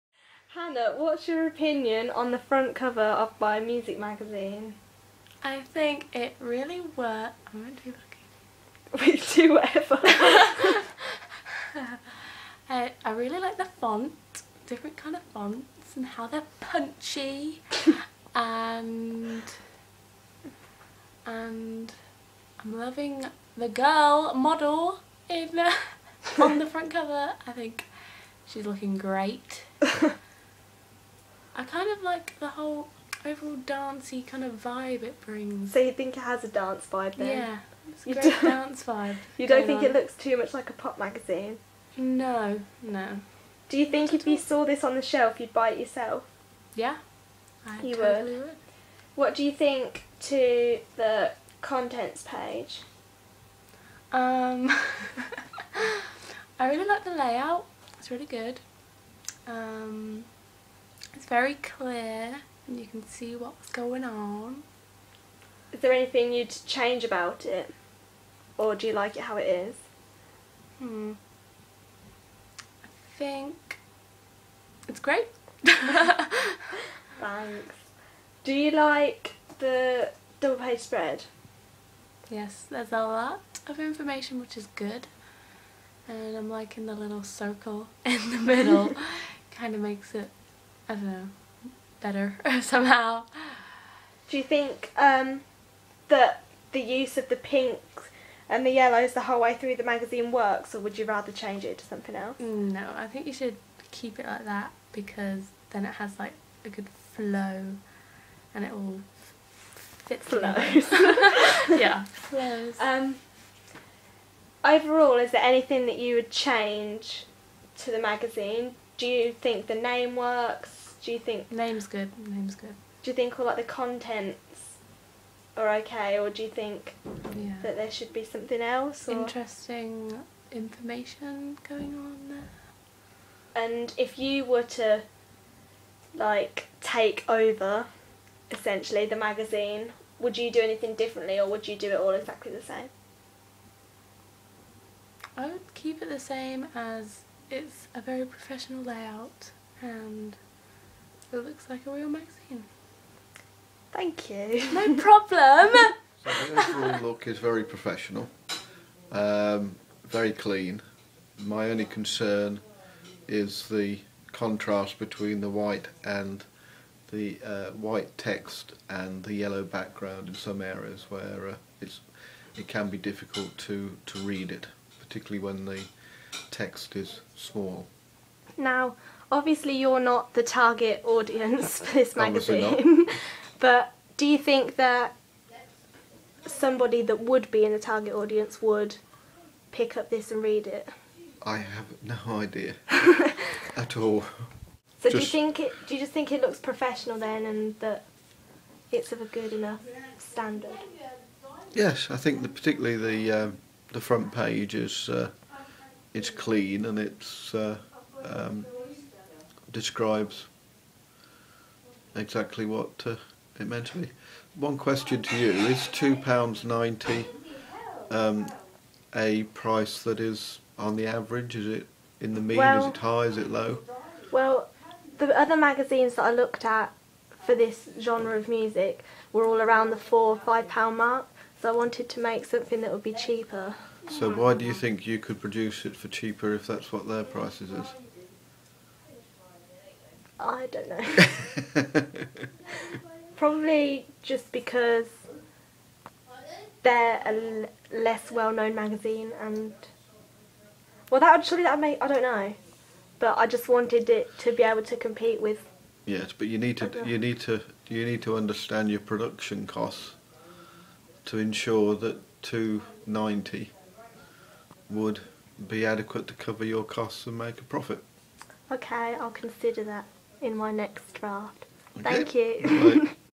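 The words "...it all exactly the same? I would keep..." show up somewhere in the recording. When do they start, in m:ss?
2:21.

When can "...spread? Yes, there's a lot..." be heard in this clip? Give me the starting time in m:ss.
1:20.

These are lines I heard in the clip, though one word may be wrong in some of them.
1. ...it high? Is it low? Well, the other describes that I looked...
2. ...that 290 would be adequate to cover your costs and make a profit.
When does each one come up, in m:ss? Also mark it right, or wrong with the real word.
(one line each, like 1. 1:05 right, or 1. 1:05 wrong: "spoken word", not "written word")
1. 3:42 wrong: "magazines", not "describes"
2. 4:21 right.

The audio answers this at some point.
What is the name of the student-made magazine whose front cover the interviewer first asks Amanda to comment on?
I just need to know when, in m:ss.
0:03.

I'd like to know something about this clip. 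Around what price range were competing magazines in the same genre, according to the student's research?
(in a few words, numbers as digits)
£4 or £5.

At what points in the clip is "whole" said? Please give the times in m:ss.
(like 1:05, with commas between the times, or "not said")
0:32, 1:39.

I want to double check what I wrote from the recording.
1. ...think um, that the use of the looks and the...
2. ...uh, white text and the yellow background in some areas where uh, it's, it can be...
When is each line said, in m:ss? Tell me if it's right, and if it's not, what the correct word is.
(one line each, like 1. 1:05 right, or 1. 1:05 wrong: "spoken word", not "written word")
1. 1:34 wrong: "pinks", not "looks"
2. 2:47 right.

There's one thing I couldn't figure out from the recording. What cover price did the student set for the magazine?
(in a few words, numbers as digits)
£2.90.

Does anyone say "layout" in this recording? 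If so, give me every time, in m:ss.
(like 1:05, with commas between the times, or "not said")
0:57, 2:28.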